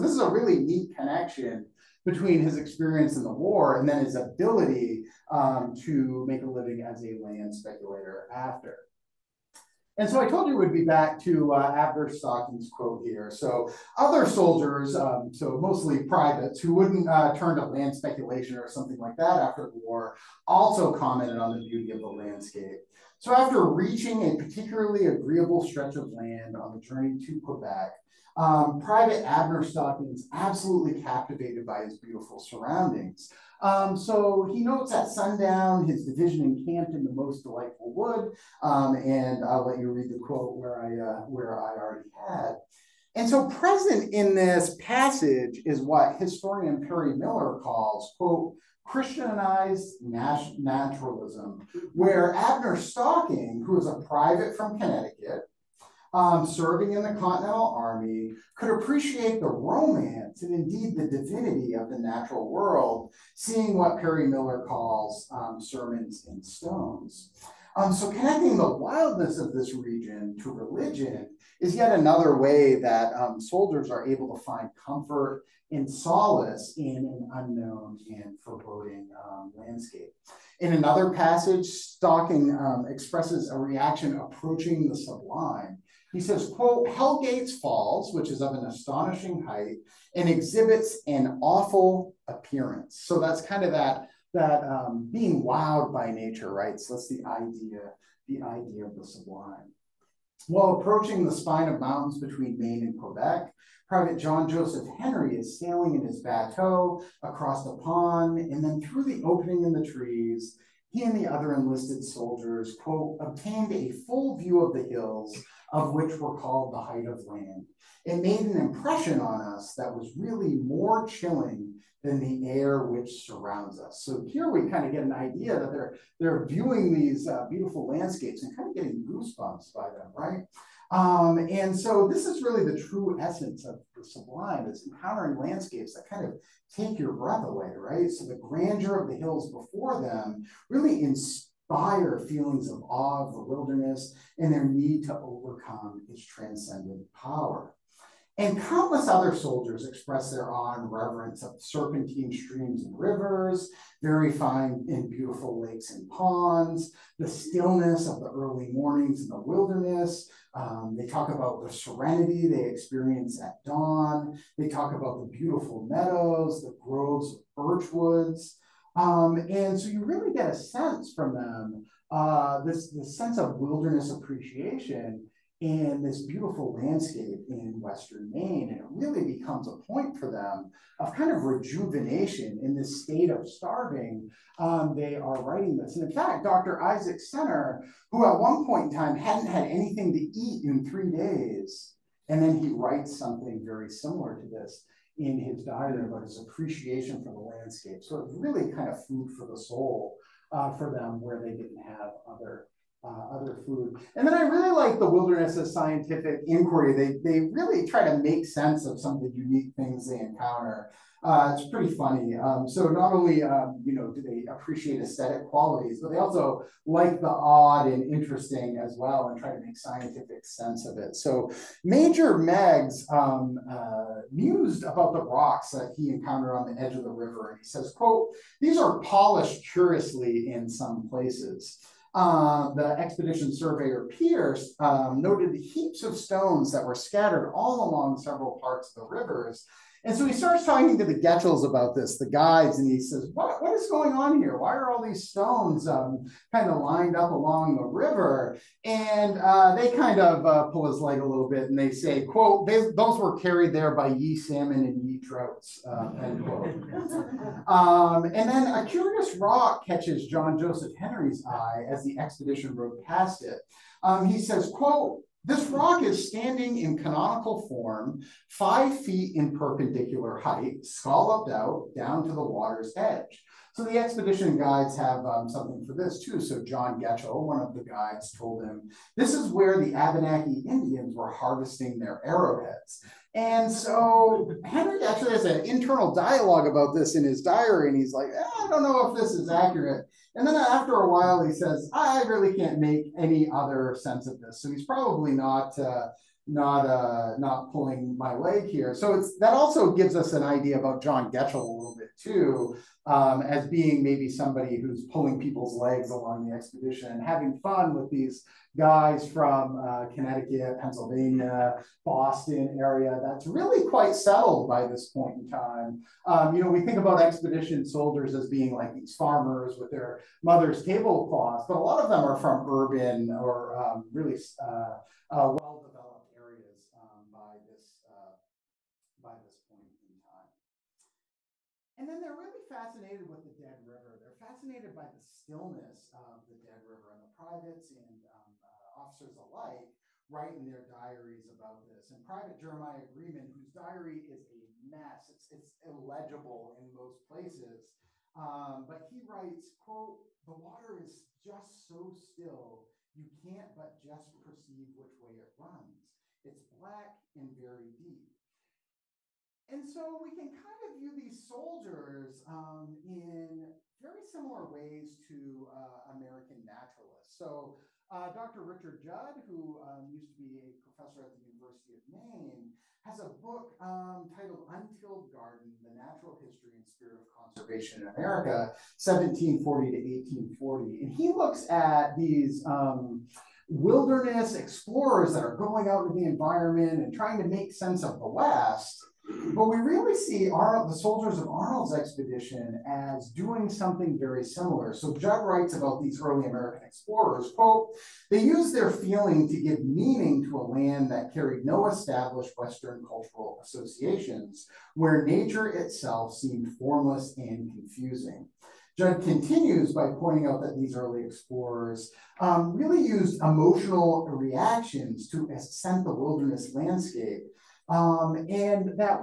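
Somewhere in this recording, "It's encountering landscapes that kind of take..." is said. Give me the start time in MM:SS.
02:14.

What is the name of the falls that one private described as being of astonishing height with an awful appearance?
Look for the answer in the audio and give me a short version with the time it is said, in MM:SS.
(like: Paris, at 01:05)
Hell Gates Falls, at 01:26.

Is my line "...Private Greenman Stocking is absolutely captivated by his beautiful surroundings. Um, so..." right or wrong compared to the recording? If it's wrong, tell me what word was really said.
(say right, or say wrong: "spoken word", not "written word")
wrong: "Abner", not "Greenman".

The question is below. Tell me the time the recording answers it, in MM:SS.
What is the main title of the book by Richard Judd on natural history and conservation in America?
06:14.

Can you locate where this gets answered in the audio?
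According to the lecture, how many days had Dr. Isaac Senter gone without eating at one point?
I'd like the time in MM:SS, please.
03:10.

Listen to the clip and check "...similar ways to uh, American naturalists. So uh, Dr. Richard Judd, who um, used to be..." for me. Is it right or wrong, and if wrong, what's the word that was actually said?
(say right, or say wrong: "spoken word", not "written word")
right.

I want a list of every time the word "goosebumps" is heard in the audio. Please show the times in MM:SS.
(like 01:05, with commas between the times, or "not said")
02:09.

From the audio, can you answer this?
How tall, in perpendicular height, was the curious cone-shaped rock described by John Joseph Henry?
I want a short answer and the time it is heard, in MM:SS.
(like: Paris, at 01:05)
5 feet, at 04:28.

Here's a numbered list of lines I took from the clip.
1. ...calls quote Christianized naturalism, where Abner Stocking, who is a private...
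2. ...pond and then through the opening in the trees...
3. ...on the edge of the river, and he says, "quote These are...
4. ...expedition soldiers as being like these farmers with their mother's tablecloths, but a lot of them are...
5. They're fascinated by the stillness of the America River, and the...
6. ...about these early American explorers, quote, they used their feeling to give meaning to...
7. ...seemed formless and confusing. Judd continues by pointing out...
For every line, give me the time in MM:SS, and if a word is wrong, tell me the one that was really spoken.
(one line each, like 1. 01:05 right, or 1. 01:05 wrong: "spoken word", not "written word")
1. 00:47 right
2. 01:47 right
3. 03:46 right
4. 05:17 right
5. 05:34 wrong: "Dead", not "America"
6. 06:35 right
7. 06:46 right.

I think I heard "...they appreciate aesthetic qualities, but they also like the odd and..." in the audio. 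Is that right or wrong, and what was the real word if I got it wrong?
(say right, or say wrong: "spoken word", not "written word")
right.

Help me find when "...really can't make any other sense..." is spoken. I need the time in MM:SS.
04:52.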